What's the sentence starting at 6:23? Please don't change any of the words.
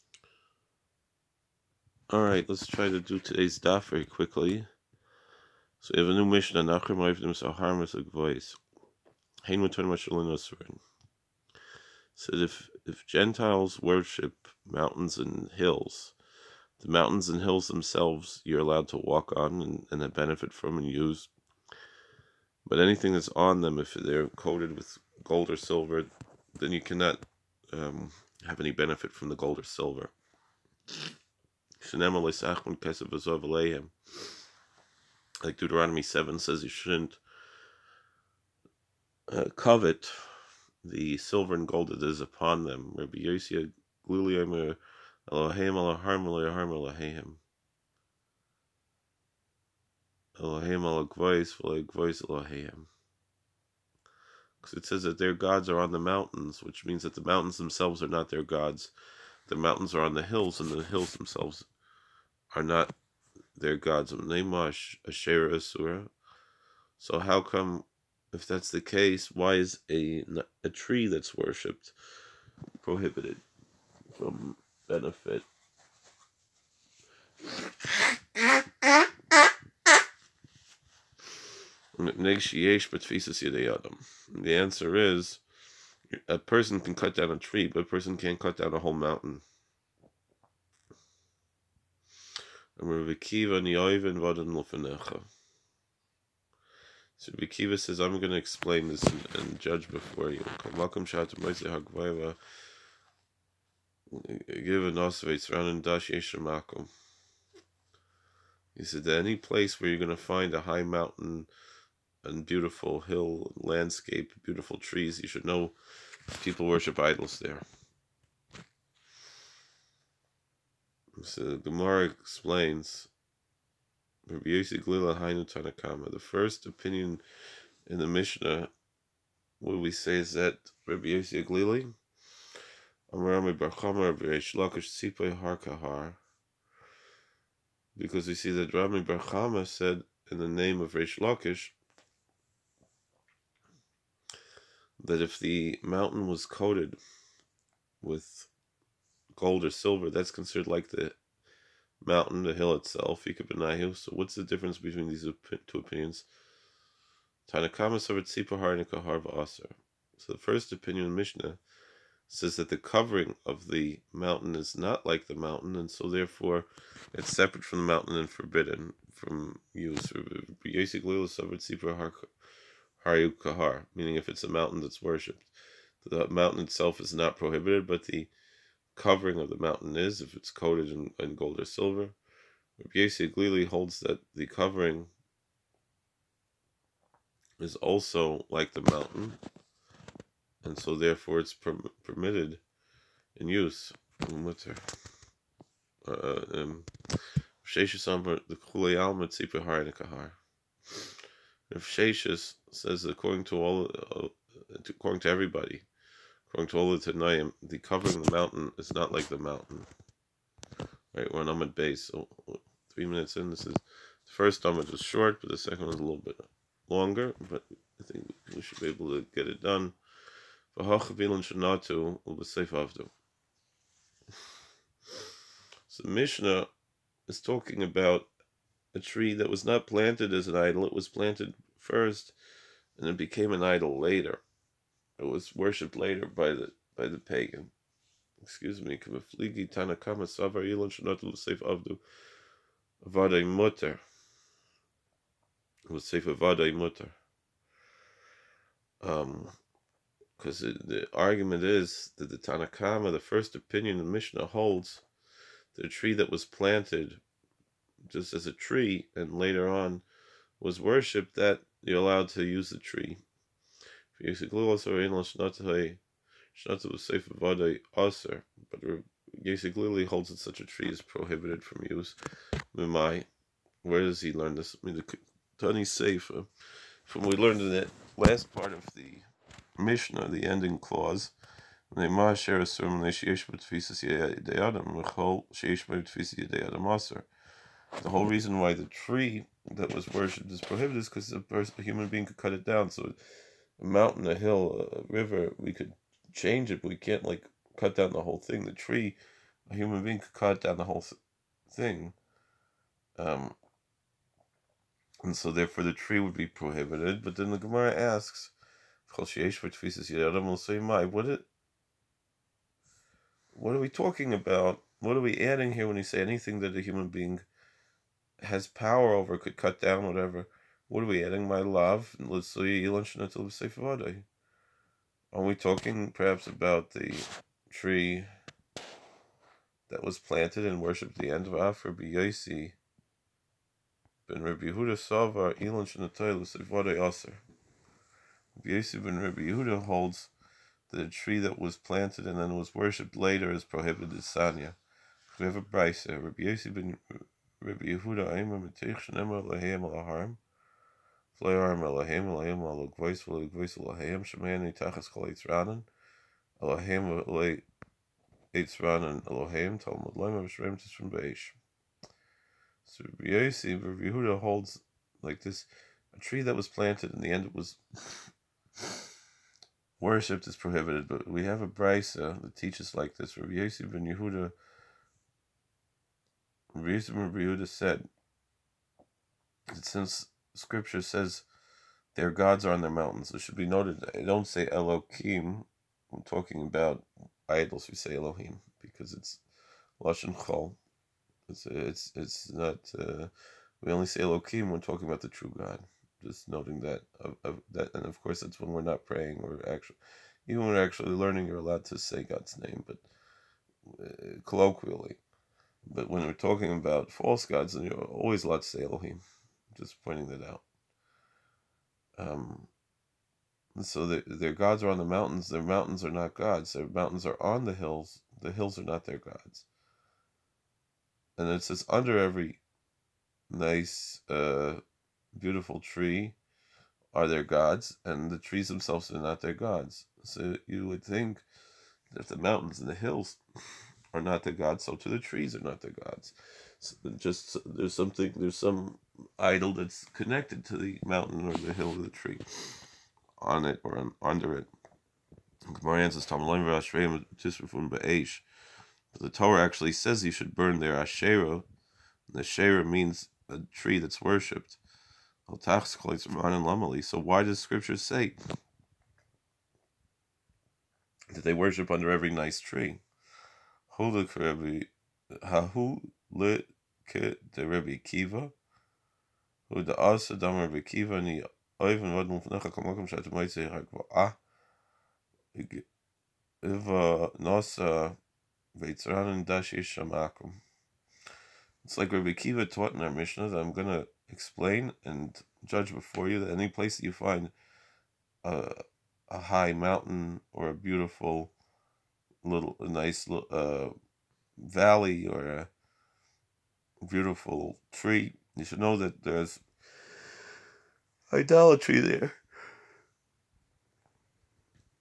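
It should be noted, I don't say Elohim.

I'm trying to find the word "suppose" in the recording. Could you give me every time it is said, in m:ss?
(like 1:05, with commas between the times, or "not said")
not said.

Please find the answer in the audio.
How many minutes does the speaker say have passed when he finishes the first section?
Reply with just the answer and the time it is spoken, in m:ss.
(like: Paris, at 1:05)
3, at 3:32.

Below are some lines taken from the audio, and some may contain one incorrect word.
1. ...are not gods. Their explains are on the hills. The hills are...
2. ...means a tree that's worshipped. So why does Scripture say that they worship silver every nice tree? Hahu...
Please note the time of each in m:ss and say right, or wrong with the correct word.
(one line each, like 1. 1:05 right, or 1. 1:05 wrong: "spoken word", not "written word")
1. 6:56 wrong: "mountains", not "explains"
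2. 7:32 wrong: "under", not "silver".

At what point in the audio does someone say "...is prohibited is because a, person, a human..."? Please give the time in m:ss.
4:50.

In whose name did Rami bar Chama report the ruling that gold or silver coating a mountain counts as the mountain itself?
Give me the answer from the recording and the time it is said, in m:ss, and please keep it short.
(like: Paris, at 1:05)
Reish Lakish, at 2:20.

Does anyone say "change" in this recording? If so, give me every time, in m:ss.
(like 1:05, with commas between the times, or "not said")
4:56.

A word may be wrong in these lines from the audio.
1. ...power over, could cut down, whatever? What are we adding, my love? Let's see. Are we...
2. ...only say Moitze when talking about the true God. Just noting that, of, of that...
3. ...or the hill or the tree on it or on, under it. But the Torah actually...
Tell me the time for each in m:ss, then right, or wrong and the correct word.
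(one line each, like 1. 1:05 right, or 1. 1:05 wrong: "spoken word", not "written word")
1. 5:18 right
2. 6:33 wrong: "Elohim", not "Moitze"
3. 7:21 right.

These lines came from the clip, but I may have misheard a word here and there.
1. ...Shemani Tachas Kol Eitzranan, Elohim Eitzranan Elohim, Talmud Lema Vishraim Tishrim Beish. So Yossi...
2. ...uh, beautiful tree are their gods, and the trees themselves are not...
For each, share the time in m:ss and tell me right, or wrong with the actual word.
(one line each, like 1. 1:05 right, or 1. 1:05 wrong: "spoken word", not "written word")
1. 5:54 right
2. 7:04 right.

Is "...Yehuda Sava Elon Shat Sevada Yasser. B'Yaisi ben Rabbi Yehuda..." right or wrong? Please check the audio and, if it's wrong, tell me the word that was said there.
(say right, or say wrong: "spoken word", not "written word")
wrong: "Shnatayla", not "Shat".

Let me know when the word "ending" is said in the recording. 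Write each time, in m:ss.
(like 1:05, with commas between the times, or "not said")
4:40.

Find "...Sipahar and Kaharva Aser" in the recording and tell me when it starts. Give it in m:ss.
2:38.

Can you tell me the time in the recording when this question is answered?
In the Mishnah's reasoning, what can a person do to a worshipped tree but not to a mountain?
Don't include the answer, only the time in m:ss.
1:26.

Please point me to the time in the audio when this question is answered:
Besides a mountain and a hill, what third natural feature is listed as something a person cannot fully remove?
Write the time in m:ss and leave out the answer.
4:54.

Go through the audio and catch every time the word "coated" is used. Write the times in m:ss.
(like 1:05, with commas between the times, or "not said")
0:24, 2:26, 3:00.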